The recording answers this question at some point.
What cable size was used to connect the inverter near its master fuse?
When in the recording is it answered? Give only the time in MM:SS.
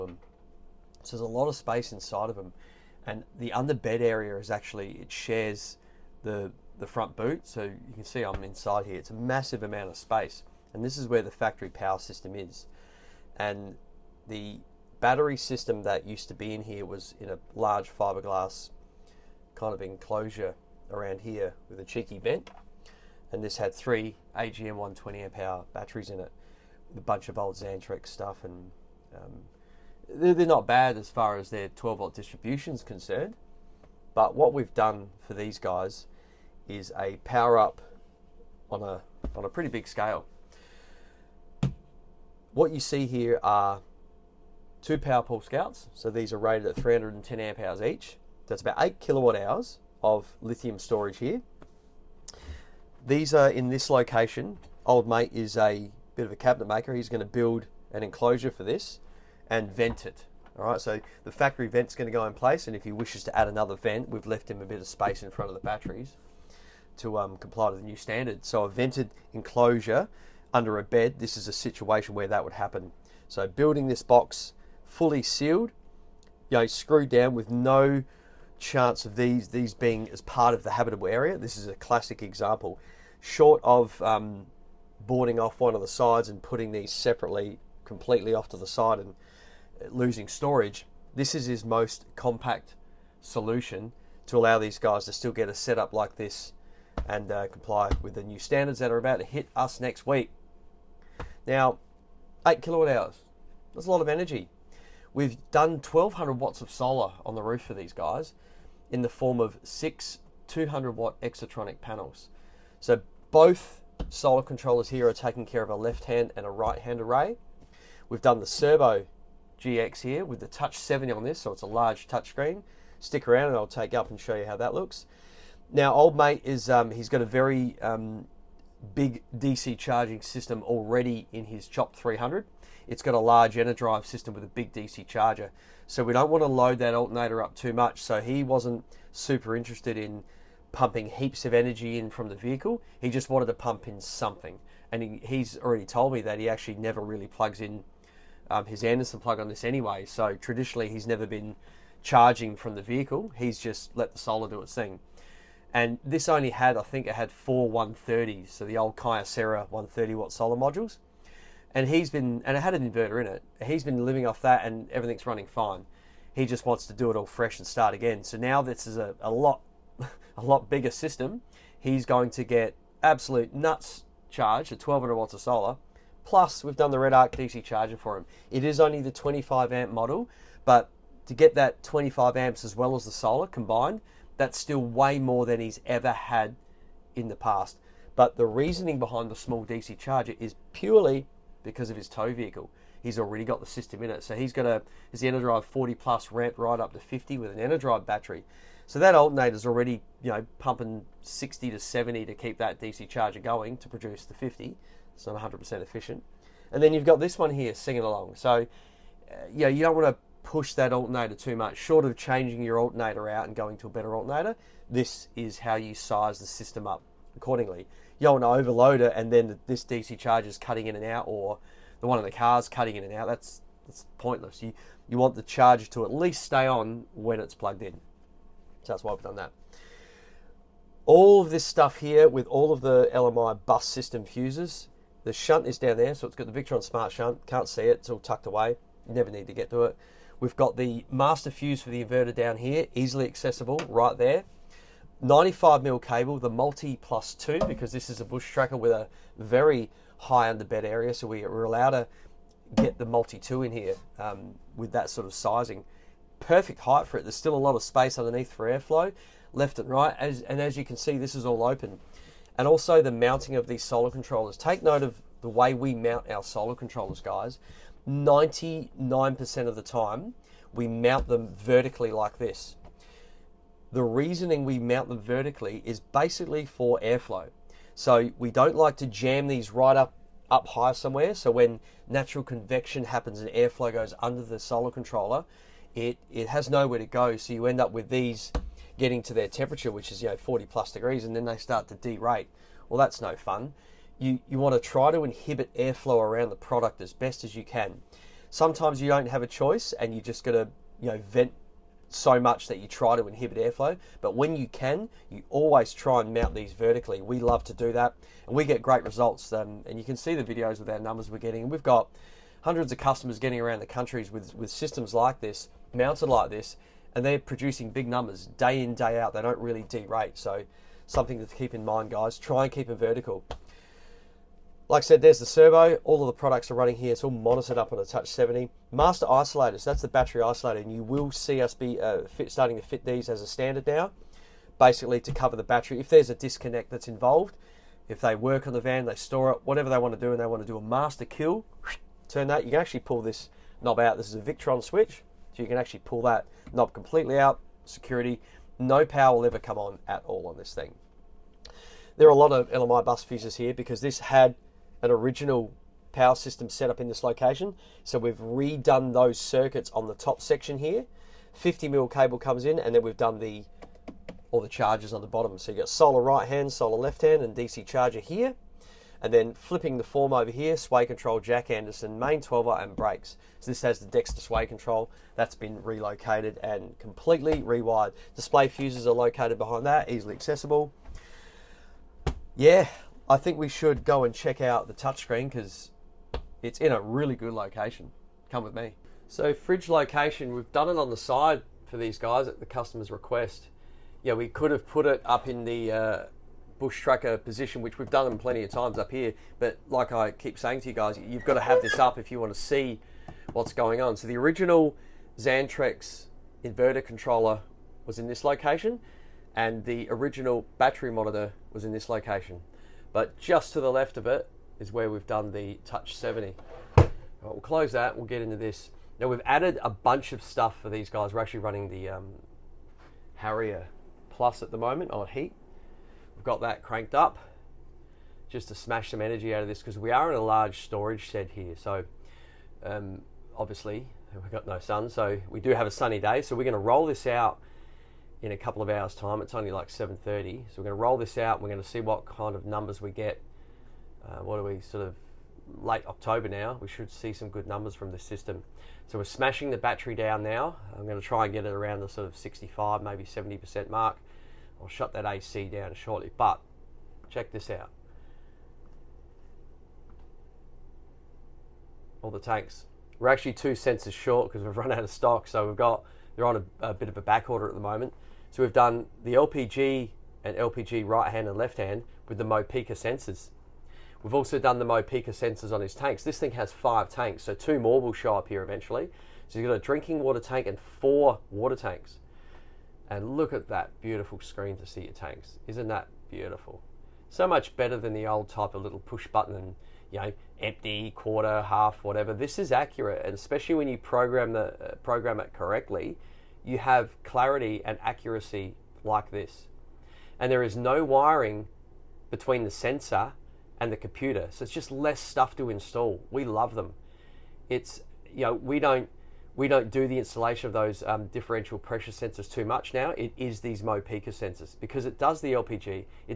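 04:05.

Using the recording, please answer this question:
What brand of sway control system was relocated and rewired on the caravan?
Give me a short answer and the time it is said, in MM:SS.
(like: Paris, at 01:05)
Dexter, at 06:14.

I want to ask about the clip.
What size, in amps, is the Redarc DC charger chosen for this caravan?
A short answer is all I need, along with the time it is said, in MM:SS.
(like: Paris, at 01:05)
25 amp, at 02:59.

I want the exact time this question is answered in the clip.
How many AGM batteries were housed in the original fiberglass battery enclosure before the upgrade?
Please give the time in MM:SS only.
00:23.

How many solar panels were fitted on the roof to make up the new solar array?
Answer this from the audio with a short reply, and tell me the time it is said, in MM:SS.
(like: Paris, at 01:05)
6, at 01:49.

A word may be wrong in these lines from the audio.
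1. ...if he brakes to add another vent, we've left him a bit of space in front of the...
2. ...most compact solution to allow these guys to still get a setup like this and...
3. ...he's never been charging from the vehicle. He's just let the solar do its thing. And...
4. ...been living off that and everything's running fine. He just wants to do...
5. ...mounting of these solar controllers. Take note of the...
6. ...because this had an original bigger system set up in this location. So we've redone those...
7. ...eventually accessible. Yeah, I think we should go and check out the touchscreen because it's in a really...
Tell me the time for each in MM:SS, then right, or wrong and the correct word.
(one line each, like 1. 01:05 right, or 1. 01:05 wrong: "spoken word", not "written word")
1. 01:02 wrong: "wishes", not "brakes"
2. 01:31 right
3. 02:30 right
4. 02:43 right
5. 04:23 right
6. 05:53 wrong: "power", not "bigger"
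7. 06:20 wrong: "easily", not "eventually".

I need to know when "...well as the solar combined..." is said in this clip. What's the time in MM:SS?
03:02.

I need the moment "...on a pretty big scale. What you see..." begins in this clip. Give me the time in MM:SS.
00:39.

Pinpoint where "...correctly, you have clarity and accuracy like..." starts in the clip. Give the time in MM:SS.
08:15.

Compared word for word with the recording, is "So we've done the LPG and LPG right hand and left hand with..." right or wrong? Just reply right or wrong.
right.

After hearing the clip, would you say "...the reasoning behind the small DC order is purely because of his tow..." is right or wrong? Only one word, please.
wrong.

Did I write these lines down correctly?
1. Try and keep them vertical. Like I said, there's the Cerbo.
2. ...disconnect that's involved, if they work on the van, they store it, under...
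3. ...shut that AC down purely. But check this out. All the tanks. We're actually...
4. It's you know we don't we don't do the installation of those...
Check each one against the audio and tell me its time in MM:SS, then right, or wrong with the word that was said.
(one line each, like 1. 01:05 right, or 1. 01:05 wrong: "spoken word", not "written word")
1. 05:22 right
2. 05:36 wrong: "whatever", not "under"
3. 07:34 wrong: "shortly", not "purely"
4. 08:27 right.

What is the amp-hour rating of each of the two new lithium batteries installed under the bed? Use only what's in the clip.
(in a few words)
310 amp hours.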